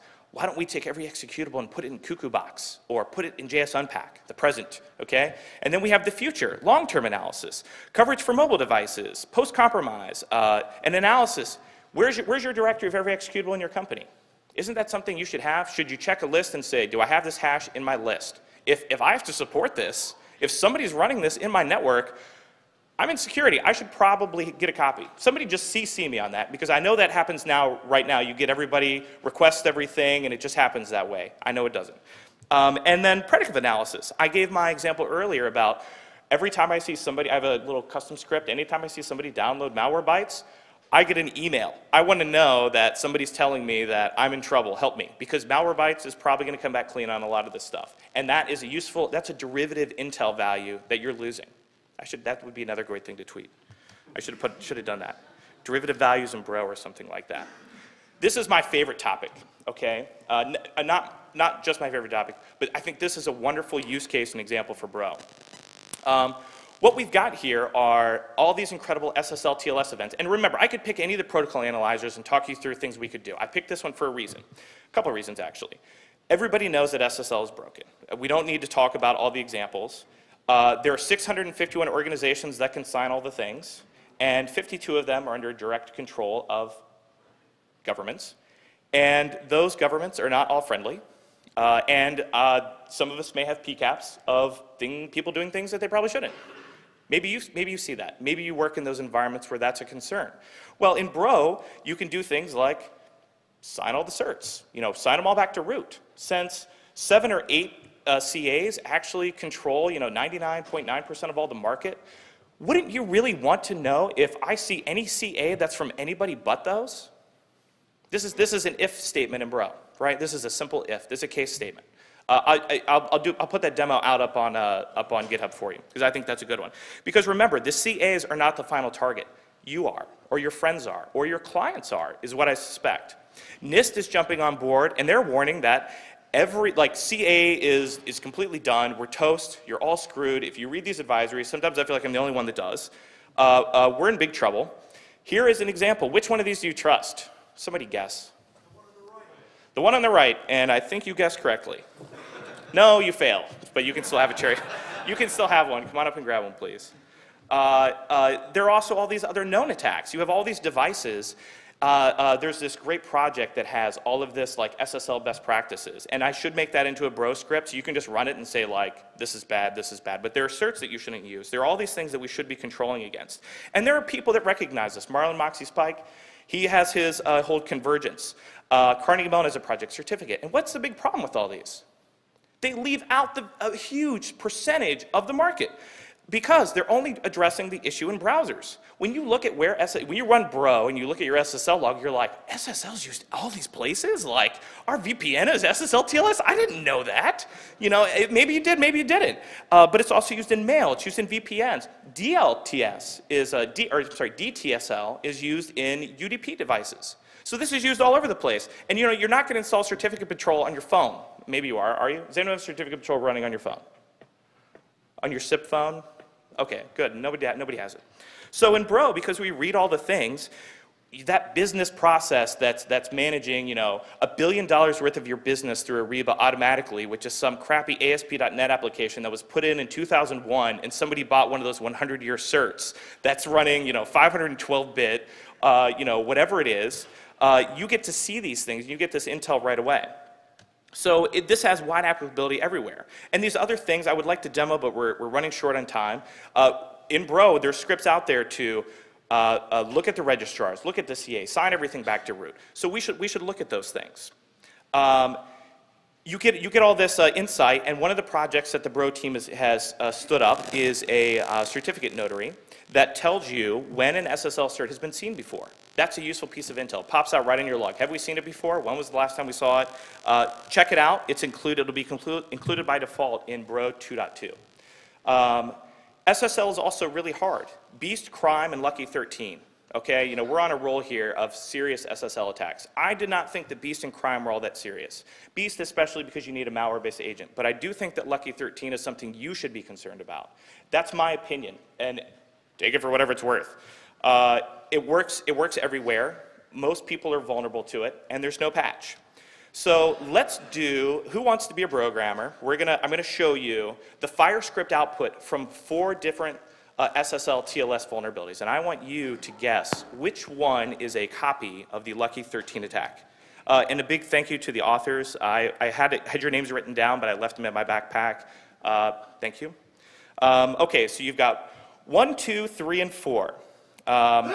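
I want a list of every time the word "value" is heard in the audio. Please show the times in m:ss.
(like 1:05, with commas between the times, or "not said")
0:50, 0:55.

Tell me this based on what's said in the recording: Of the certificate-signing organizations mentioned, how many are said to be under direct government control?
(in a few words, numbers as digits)
52.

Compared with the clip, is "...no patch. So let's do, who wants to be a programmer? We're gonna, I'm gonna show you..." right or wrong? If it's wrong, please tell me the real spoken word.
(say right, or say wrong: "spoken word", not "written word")
right.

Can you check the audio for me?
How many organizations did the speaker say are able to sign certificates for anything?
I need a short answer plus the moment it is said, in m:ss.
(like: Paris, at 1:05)
651, at 1:20.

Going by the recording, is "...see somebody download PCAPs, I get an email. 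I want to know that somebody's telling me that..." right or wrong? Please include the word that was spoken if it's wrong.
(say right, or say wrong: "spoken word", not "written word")
wrong: "Malwarebytes", not "PCAPs".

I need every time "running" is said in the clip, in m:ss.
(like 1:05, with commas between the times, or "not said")
0:20, 3:33, 3:53, 4:05.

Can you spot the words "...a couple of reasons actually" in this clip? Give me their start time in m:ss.
1:14.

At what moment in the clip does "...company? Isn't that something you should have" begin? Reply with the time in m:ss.
0:13.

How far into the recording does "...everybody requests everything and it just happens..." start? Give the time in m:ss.
0:28.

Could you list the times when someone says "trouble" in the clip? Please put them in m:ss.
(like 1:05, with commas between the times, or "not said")
0:44, 2:24.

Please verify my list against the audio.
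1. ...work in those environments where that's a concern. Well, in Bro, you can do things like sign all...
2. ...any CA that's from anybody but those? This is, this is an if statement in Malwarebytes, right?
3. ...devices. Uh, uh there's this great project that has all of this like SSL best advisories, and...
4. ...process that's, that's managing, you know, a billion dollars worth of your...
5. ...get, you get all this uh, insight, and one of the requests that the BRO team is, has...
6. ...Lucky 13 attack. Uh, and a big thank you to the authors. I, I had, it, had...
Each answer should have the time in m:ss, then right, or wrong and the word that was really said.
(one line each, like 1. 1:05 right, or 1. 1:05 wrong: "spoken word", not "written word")
1. 1:38 right
2. 1:54 wrong: "Bro", not "Malwarebytes"
3. 2:40 wrong: "practices", not "advisories"
4. 3:41 right
5. 4:16 wrong: "projects", not "requests"
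6. 5:12 right.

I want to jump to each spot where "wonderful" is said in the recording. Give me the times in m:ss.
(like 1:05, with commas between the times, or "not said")
1:03.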